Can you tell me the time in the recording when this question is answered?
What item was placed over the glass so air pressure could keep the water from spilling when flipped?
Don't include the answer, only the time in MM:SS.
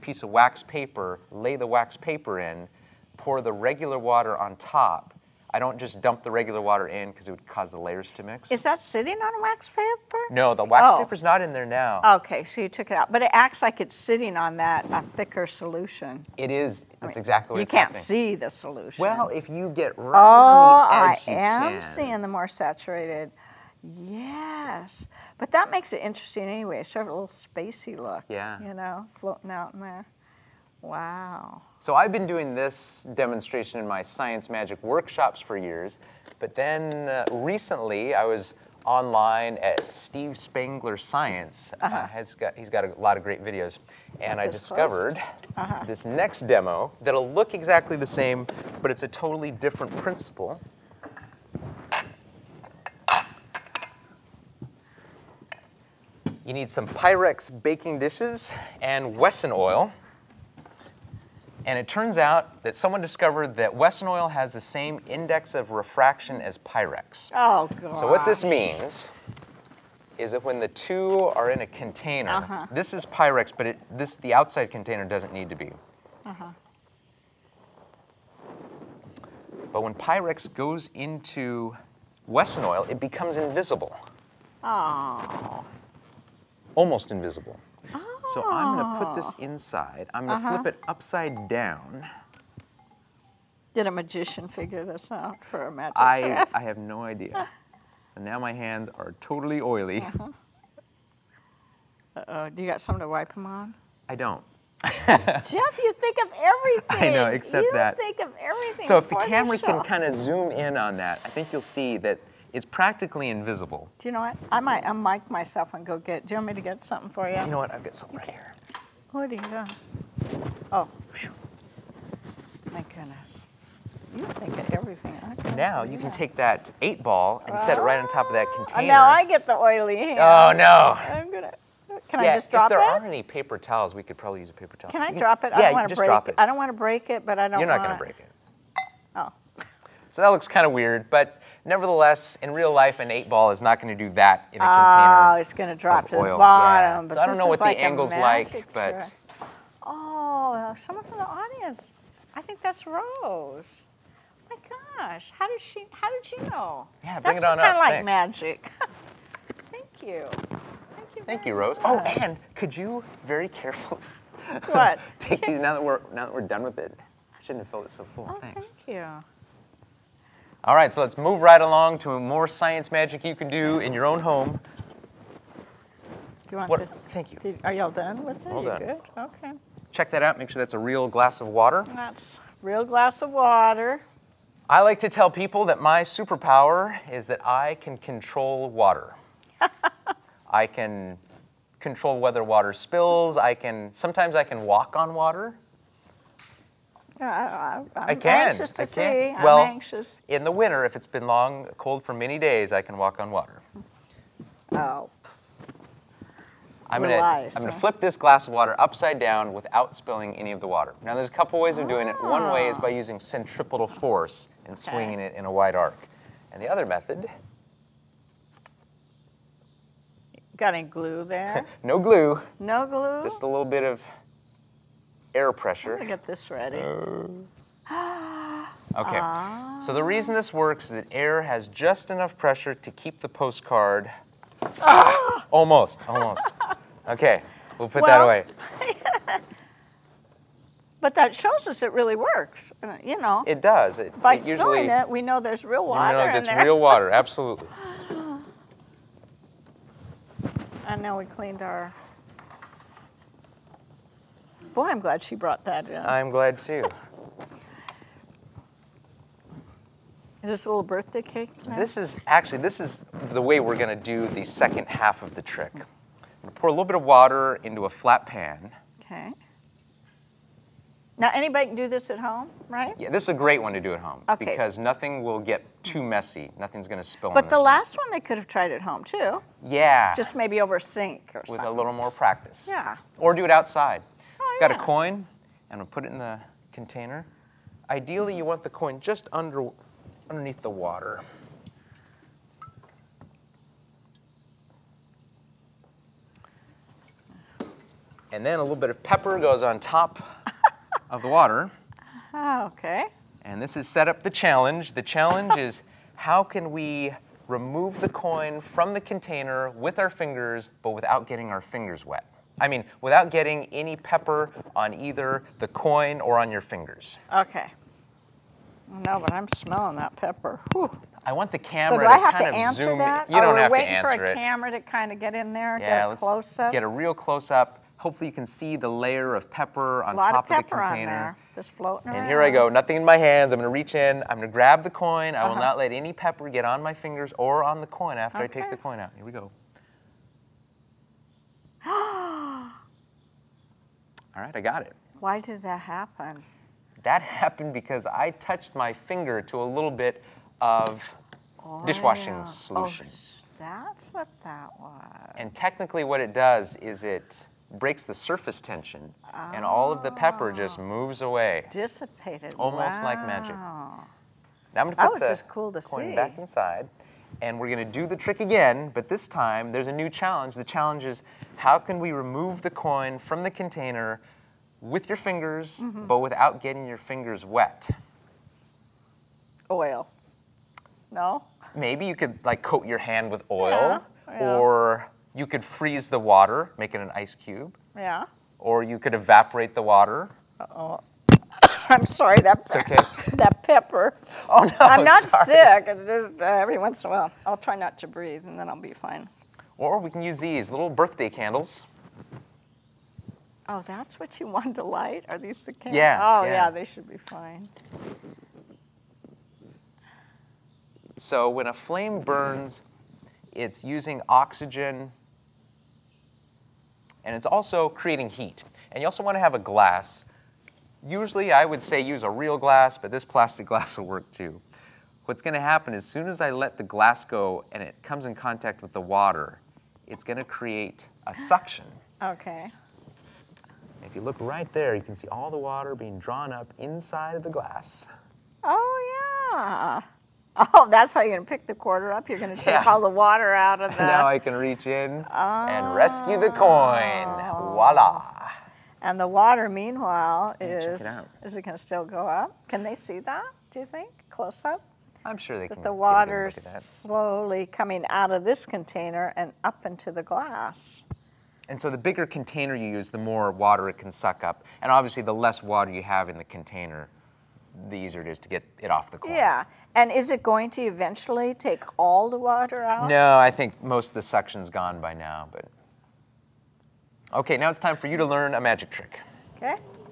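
03:53.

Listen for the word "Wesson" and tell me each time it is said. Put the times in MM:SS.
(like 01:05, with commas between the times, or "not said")
00:59, 01:03, 01:22.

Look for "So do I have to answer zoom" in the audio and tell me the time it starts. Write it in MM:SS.
05:21.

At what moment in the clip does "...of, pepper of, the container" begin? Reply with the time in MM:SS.
05:30.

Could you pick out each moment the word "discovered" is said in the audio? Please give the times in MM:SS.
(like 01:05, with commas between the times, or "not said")
00:44, 01:03.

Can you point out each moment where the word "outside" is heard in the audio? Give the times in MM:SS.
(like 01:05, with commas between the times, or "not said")
01:14, 04:43.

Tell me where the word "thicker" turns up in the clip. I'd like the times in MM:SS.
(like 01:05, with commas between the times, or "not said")
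00:15.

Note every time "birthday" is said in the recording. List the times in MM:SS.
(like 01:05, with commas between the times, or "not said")
04:20, 06:40.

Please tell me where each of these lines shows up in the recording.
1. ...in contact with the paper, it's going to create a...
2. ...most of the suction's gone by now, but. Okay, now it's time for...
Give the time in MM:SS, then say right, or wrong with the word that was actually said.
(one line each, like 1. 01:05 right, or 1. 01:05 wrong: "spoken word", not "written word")
1. 07:08 wrong: "water", not "paper"
2. 07:53 right.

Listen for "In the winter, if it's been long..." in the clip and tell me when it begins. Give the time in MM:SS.
03:20.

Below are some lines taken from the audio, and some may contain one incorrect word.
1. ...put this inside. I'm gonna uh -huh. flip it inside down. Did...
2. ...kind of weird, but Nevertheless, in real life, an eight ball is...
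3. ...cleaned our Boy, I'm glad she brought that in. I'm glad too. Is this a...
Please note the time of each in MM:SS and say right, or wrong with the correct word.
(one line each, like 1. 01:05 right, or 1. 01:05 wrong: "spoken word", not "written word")
1. 01:29 wrong: "upside", not "inside"
2. 02:20 right
3. 04:11 right.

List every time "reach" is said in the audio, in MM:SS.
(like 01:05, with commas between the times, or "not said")
05:33, 07:24.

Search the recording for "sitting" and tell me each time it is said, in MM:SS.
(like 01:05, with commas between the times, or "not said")
00:08, 00:13.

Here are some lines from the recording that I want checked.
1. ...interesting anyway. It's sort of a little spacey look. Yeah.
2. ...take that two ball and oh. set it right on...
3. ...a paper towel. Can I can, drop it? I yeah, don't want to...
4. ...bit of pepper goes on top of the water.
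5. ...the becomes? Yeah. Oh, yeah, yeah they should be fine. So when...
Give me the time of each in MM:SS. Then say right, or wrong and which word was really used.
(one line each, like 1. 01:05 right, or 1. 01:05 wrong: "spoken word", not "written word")
1. 00:26 right
2. 02:06 wrong: "eight", not "two"
3. 02:14 right
4. 04:58 right
5. 06:45 wrong: "candles", not "becomes".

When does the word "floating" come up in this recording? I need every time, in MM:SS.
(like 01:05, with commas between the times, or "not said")
00:29, 05:31.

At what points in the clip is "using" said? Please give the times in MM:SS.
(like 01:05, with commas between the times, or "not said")
03:32, 06:53.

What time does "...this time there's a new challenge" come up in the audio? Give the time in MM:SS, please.
06:09.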